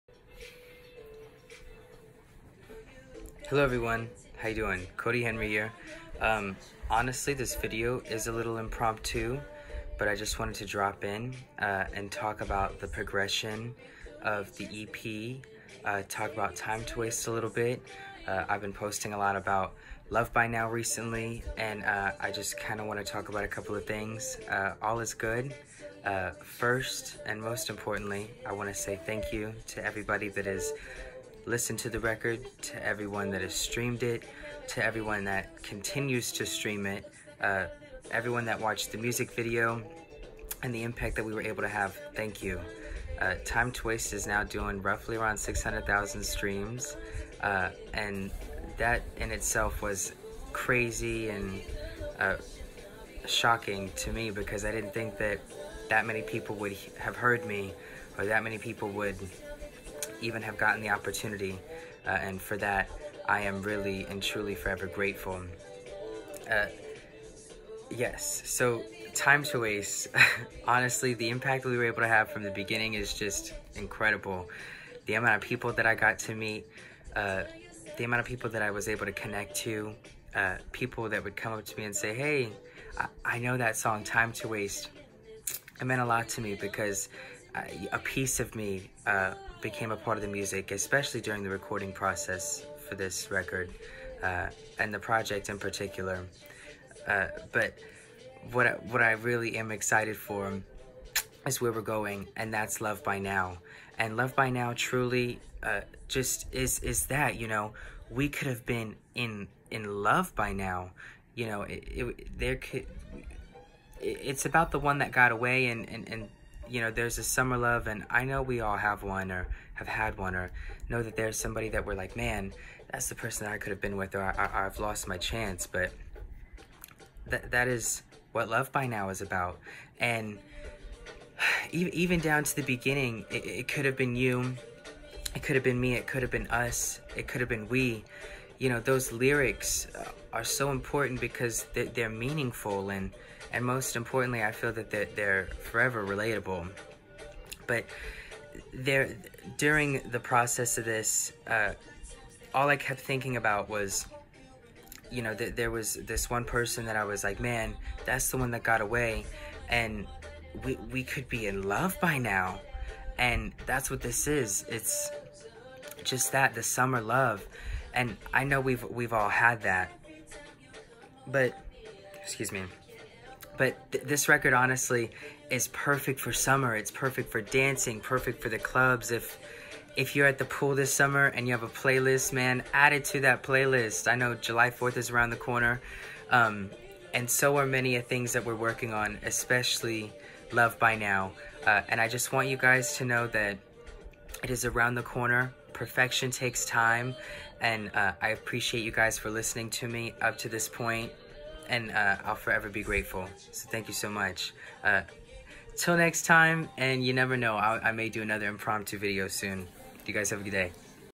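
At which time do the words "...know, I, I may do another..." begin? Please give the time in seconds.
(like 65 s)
207 s.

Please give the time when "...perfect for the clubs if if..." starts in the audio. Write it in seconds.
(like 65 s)
177 s.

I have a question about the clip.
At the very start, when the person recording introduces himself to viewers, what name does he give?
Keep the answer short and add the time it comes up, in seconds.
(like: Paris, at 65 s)
Kody Henry, at 4 s.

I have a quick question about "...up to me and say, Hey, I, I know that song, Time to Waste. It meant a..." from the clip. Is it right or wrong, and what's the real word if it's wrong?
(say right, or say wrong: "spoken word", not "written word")
right.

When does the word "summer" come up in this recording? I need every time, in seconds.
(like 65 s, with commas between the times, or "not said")
117 s, 166 s, 176 s, 180 s.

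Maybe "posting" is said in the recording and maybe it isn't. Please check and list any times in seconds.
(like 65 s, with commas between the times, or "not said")
18 s.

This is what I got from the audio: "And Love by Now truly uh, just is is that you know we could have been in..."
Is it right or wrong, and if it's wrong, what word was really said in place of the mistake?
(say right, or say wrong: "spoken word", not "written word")
right.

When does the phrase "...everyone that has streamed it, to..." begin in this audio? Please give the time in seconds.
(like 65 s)
32 s.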